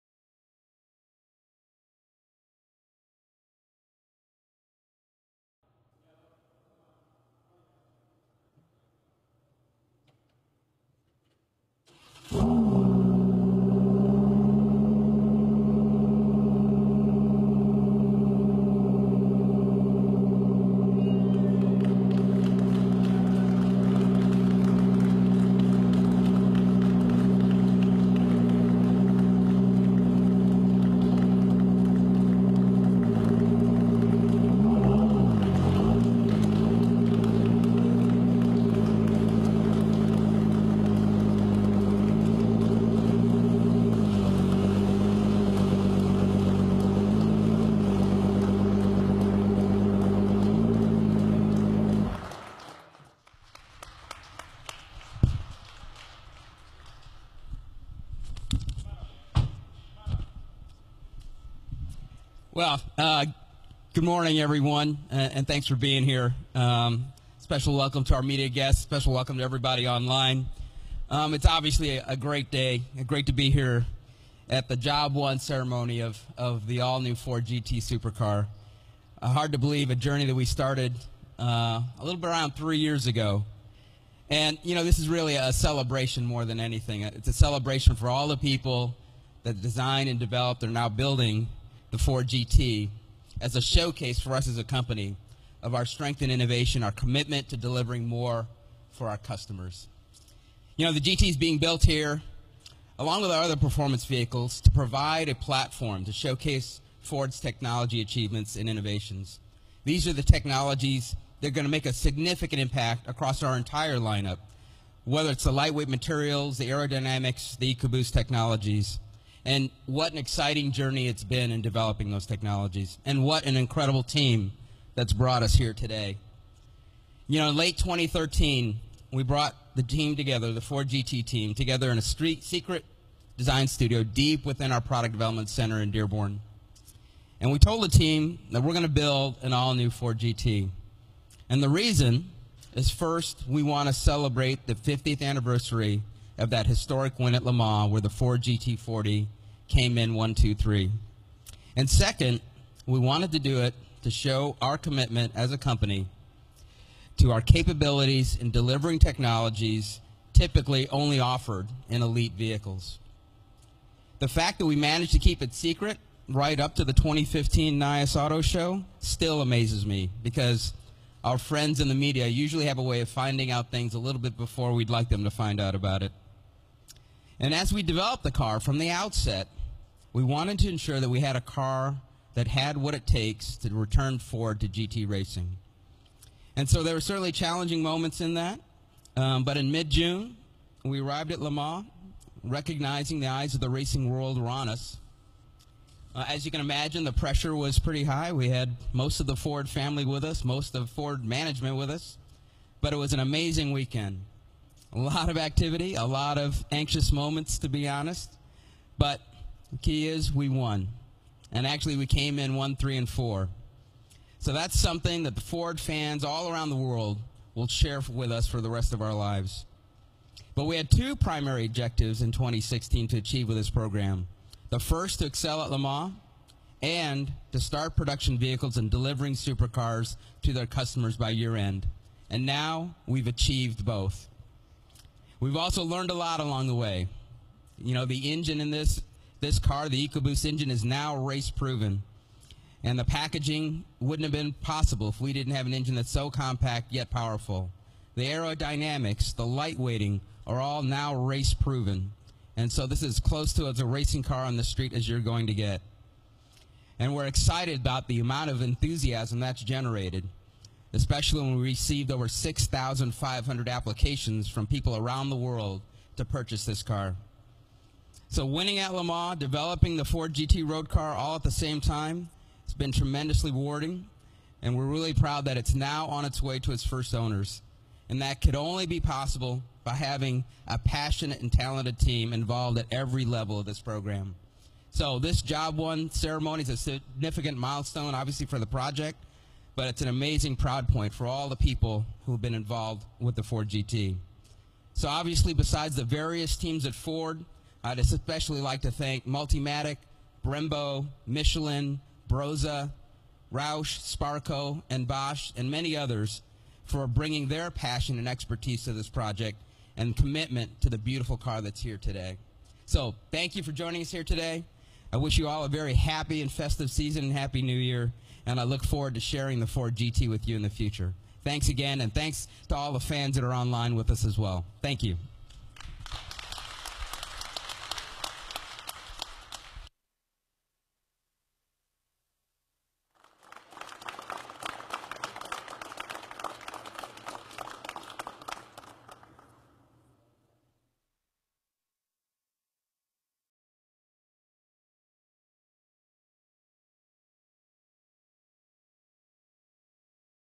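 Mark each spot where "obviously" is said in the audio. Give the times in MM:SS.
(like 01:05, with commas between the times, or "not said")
01:11, 04:48, 04:55.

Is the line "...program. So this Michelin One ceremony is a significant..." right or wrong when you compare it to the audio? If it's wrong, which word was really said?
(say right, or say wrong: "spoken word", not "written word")
wrong: "Job", not "Michelin".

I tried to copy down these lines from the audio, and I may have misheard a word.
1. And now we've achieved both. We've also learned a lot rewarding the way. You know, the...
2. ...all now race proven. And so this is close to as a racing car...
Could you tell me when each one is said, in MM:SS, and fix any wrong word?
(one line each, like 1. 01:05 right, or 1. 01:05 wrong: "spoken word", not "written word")
1. 03:52 wrong: "along", not "rewarding"
2. 04:10 right.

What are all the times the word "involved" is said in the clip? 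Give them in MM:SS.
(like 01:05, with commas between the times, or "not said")
04:42, 04:52.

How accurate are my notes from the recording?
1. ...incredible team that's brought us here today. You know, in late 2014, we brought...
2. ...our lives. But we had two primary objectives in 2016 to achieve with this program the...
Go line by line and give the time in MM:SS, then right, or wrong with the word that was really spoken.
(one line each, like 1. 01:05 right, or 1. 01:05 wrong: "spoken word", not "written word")
1. 02:03 wrong: "2013", not "2014"
2. 03:39 right.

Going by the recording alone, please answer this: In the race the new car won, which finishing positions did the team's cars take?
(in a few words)
1, 3 and 4.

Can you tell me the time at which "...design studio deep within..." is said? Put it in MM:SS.
02:13.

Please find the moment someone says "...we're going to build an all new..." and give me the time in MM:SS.
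02:18.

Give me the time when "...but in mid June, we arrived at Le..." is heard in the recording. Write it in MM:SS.
03:09.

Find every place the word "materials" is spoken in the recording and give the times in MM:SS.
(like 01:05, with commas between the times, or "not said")
01:55.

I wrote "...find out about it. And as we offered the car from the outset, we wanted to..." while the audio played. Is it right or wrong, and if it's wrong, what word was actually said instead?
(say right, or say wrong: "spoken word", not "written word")
wrong: "developed", not "offered".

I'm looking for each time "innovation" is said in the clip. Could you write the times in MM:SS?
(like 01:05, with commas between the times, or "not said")
01:36, 01:48.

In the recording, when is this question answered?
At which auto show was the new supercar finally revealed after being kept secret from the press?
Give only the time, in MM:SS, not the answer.
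02:47.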